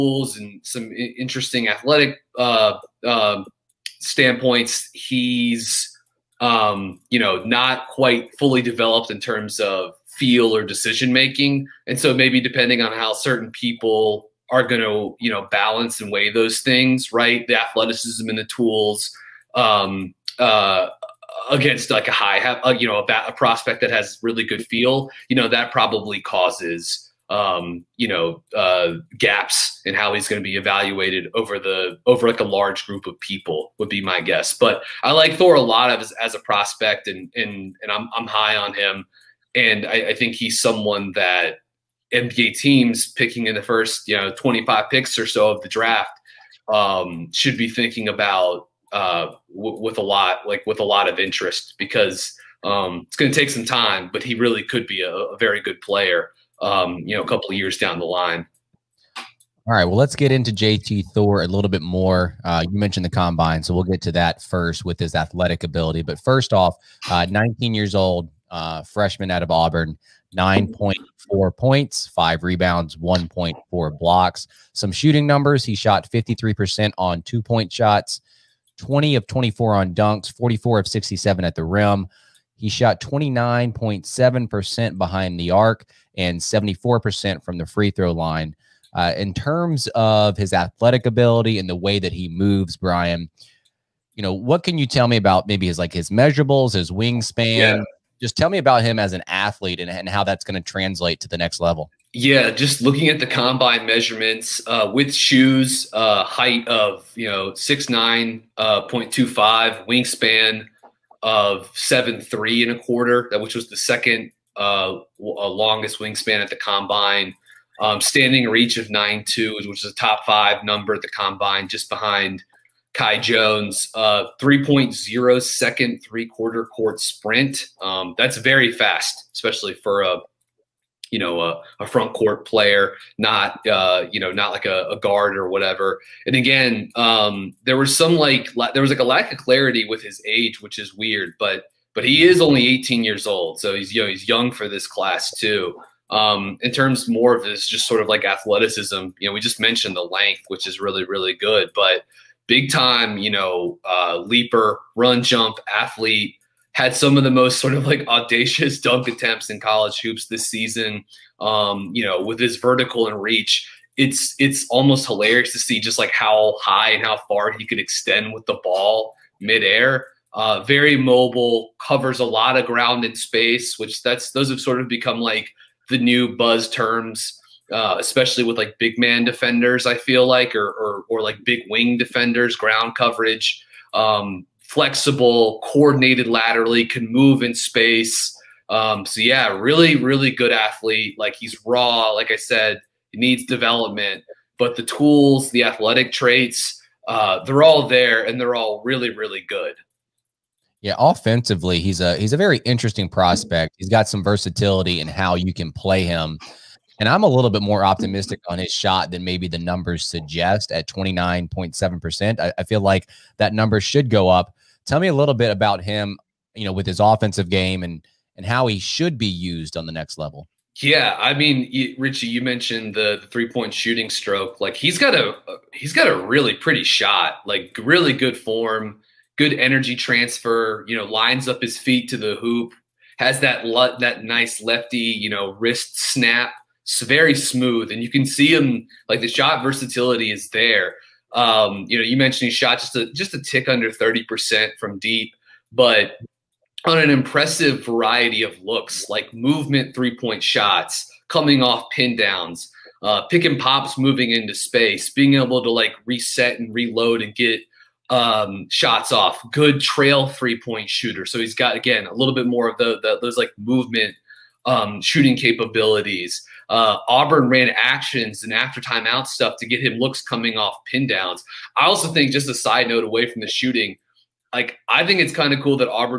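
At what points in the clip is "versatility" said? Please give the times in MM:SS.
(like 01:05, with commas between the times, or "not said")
03:24, 03:59.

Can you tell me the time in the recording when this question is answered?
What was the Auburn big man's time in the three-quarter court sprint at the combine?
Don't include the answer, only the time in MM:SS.
02:04.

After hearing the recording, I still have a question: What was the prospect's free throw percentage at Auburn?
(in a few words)
74%.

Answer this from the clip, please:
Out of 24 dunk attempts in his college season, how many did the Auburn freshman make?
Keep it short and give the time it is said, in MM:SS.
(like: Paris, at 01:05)
20, at 01:18.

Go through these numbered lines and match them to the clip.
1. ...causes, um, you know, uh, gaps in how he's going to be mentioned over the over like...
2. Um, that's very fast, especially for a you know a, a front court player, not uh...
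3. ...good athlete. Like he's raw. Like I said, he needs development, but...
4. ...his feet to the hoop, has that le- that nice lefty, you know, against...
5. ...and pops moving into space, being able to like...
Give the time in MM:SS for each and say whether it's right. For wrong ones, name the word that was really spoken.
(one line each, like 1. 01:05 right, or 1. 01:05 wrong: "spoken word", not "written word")
1. 00:26 wrong: "evaluated", not "mentioned"
2. 02:07 right
3. 03:10 right
4. 03:51 wrong: "wrist", not "against"
5. 04:13 right.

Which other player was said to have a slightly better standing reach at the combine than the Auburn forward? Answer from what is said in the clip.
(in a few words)
Kai Jones.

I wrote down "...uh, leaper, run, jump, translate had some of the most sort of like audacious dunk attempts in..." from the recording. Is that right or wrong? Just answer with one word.
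wrong.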